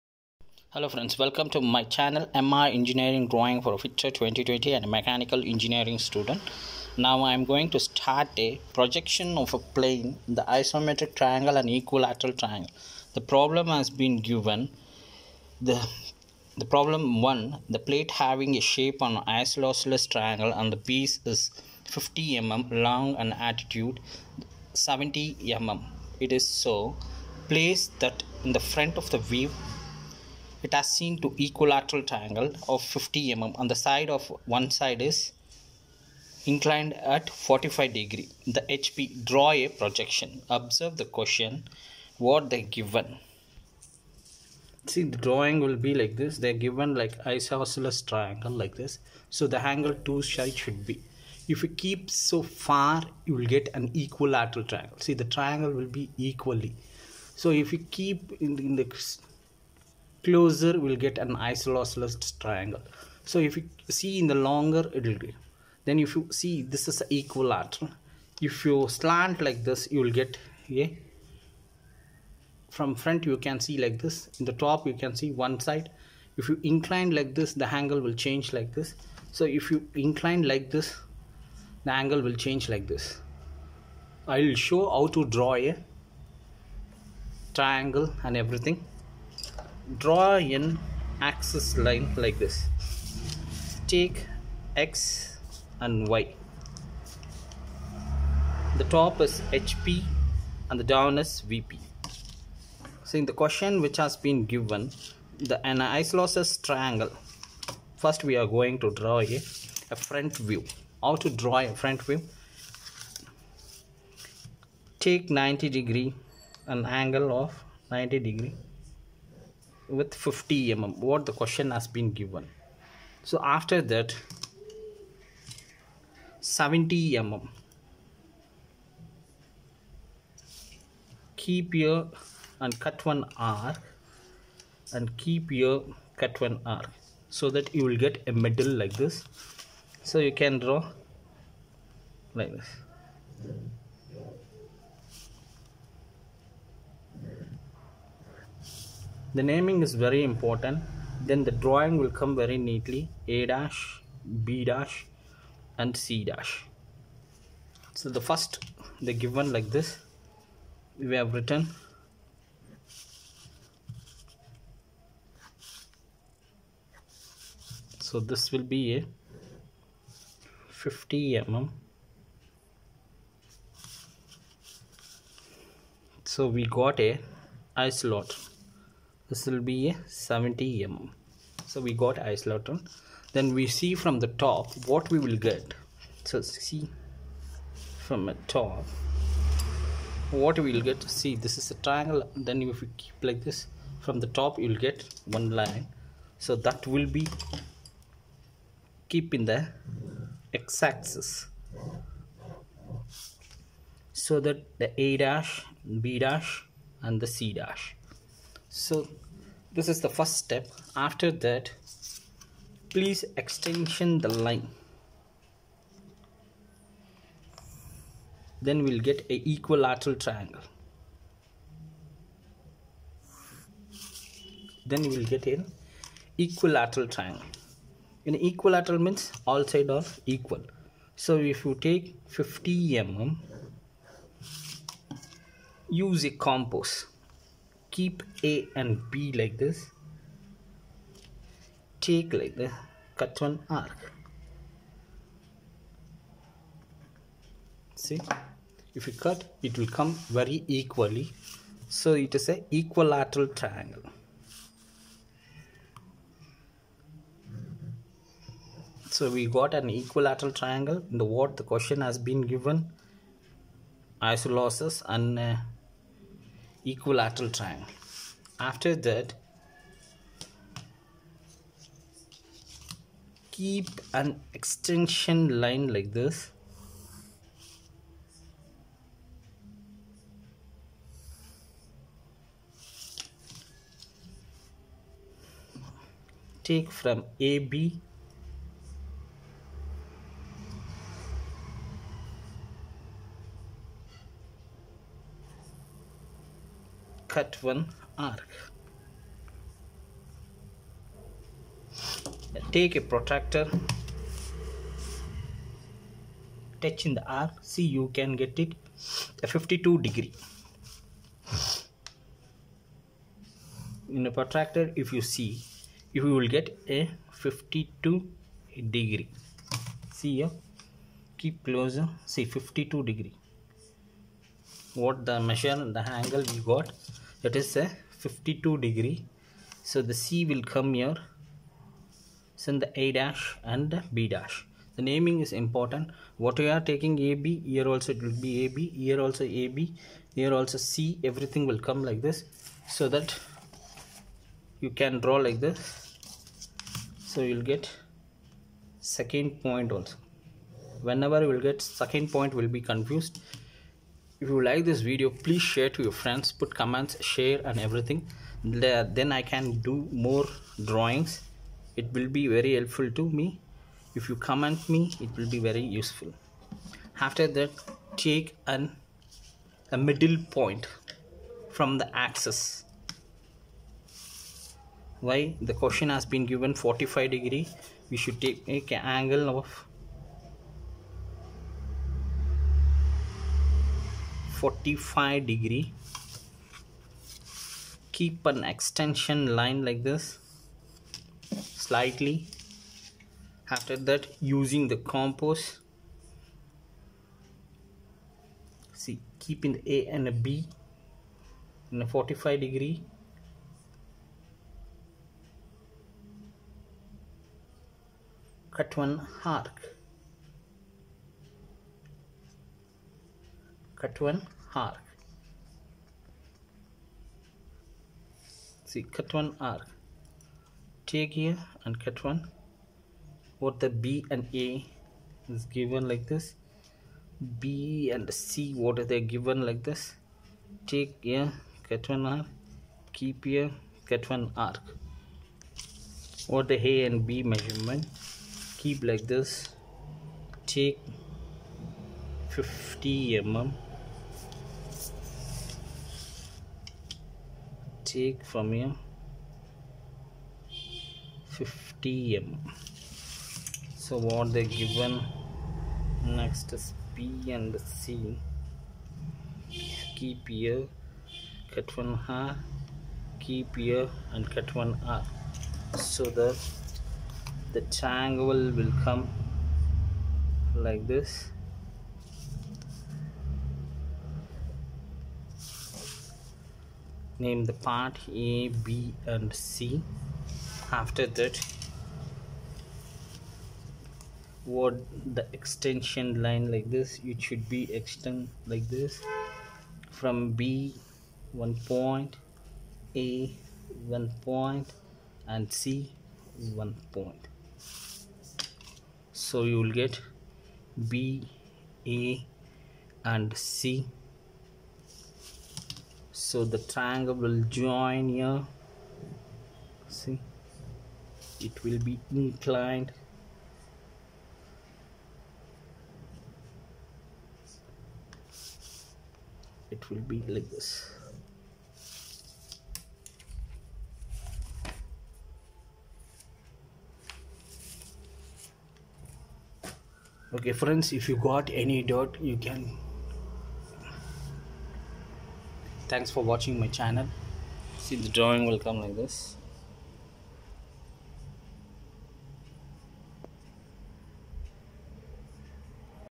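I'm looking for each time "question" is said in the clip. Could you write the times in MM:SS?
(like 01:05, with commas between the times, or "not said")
00:41, 01:43, 02:01, 04:21, 06:15.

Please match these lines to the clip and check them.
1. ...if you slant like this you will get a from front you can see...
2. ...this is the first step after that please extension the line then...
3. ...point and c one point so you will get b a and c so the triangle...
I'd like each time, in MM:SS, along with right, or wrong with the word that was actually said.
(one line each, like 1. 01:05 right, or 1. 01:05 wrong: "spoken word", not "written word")
1. 01:08 right
2. 03:29 right
3. 08:14 right.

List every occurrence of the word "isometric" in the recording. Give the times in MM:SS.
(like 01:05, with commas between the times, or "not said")
00:10.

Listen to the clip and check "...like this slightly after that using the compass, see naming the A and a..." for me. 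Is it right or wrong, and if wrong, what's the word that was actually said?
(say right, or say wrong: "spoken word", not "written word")
wrong: "keeping", not "naming".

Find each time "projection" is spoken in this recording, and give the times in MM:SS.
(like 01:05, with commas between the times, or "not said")
00:08, 00:39.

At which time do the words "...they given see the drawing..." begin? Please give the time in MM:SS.
00:42.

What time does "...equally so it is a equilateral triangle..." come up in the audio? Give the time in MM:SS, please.
04:10.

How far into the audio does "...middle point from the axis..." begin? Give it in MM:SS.
06:10.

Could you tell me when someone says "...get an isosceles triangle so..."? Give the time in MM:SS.
01:01.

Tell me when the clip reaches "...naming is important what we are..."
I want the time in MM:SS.
05:35.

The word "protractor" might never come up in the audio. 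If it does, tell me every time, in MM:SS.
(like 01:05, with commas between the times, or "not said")
05:03, 05:14.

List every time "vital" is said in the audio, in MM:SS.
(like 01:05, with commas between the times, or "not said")
not said.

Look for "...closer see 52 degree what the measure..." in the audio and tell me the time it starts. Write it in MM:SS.
05:21.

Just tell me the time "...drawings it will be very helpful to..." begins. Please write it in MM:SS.
06:00.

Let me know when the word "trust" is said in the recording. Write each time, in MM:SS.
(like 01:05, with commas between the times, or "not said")
not said.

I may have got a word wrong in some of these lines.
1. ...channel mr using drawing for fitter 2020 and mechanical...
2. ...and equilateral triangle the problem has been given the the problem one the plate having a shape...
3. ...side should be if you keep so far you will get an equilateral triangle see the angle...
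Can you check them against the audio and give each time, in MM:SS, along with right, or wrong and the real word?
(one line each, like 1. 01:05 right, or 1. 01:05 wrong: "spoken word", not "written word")
1. 00:01 wrong: "engineering", not "using"
2. 00:11 right
3. 00:50 wrong: "triangle", not "angle".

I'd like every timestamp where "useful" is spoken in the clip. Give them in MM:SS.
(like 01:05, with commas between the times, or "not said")
06:05.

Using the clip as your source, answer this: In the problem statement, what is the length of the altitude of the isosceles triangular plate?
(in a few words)
70 mm.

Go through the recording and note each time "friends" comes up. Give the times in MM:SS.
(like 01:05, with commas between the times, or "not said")
00:00, 05:56, 08:50.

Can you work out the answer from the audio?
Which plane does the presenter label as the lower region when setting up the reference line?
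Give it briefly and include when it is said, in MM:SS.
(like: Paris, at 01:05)
VP, at 01:40.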